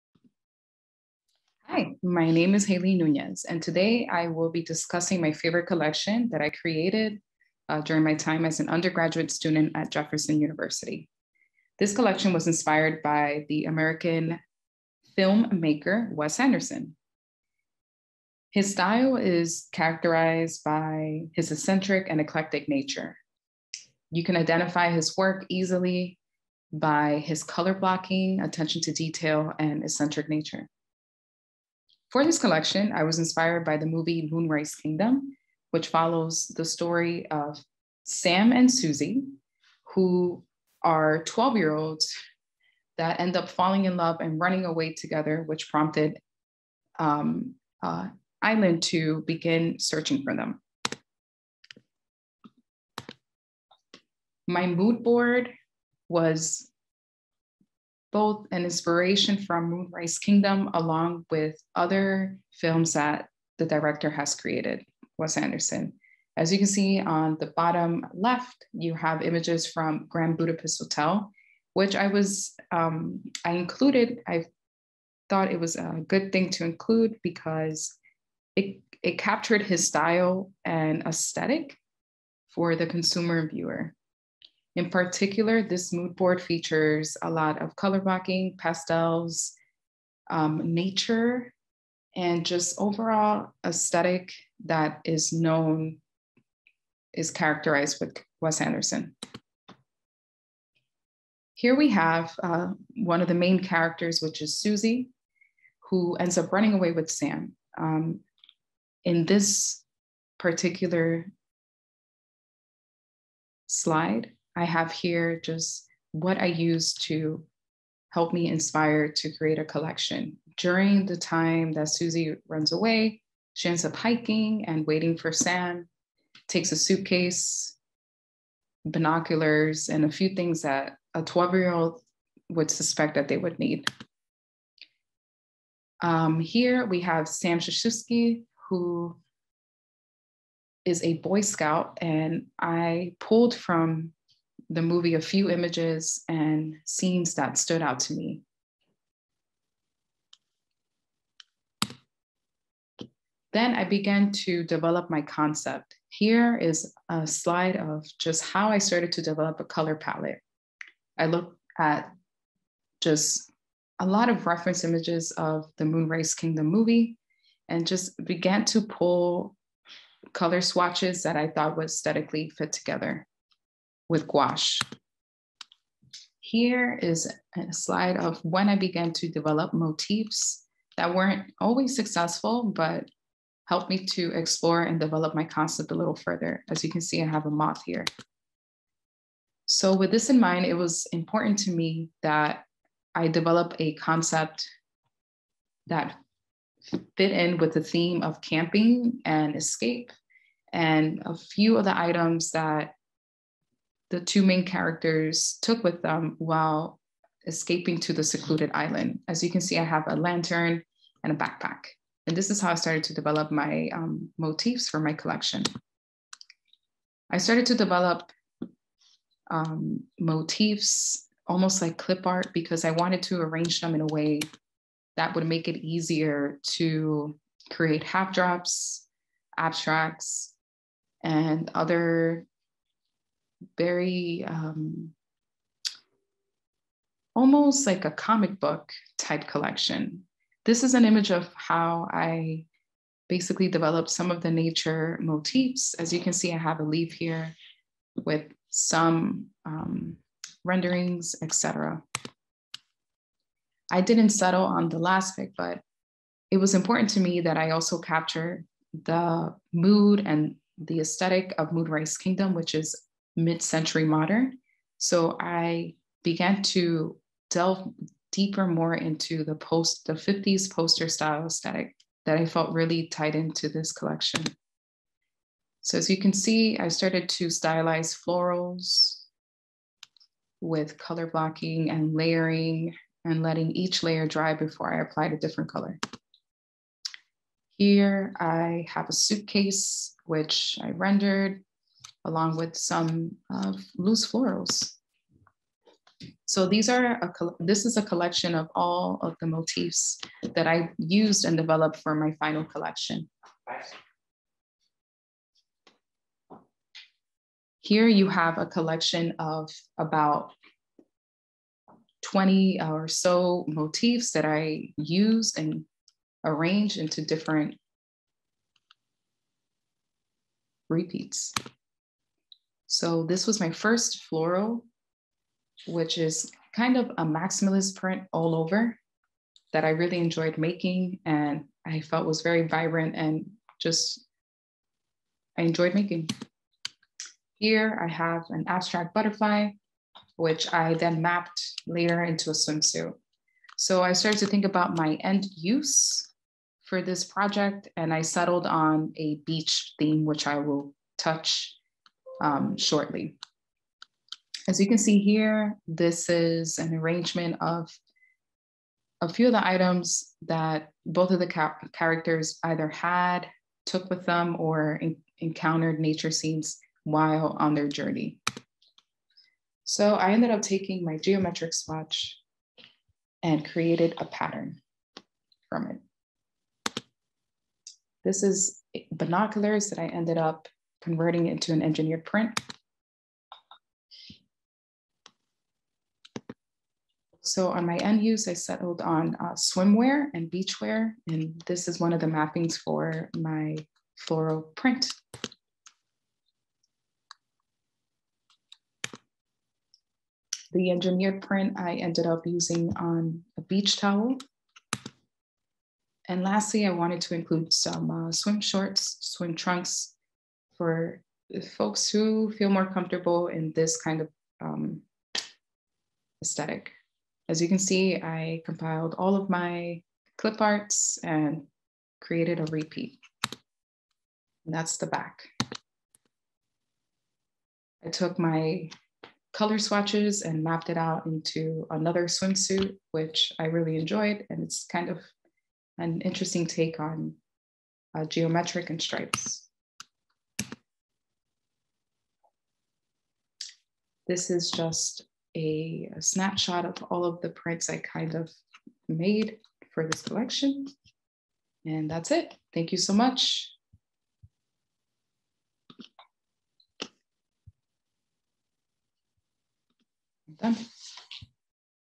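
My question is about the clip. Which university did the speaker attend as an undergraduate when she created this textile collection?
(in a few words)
Jefferson University.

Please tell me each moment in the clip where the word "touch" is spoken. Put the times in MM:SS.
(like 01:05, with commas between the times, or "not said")
05:51.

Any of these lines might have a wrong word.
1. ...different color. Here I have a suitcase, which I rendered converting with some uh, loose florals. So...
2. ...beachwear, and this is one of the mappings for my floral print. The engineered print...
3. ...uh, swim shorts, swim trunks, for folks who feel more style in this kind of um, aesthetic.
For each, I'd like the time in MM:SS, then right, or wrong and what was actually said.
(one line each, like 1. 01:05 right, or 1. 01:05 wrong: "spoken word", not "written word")
1. 04:45 wrong: "along", not "converting"
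2. 06:30 right
3. 06:48 wrong: "comfortable", not "style".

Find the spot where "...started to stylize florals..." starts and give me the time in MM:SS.
04:36.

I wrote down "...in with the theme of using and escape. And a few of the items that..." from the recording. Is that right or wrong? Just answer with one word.
wrong.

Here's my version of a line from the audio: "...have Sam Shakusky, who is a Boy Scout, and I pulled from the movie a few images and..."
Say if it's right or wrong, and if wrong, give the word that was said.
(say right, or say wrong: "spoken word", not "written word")
right.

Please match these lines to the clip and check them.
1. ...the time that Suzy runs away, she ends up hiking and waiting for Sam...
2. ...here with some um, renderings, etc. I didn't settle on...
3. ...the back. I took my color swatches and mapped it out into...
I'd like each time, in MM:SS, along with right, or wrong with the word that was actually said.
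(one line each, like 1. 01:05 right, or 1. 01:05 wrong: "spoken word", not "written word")
1. 02:01 right
2. 04:07 right
3. 07:04 right.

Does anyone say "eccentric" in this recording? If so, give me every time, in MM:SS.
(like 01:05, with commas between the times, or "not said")
00:21, 00:29.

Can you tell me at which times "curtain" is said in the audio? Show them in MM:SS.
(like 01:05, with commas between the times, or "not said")
not said.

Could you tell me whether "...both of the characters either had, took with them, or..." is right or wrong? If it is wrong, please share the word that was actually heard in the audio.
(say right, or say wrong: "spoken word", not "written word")
right.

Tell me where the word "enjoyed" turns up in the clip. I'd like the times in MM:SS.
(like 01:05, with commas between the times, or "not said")
05:30, 05:35, 07:13.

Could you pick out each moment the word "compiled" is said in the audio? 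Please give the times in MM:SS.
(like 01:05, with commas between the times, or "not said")
06:58.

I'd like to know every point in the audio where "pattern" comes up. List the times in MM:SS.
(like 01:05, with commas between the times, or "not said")
06:14.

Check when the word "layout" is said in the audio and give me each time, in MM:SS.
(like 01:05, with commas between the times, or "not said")
not said.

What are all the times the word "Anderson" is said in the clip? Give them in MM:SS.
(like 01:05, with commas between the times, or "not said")
00:16, 01:05, 01:38.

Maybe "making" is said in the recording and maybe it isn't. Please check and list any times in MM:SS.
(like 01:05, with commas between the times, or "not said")
05:30, 05:35.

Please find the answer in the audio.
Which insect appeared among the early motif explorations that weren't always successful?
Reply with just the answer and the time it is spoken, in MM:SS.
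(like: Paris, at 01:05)
A moth, at 03:07.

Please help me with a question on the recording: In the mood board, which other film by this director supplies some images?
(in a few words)
Grand Budapest Hotel.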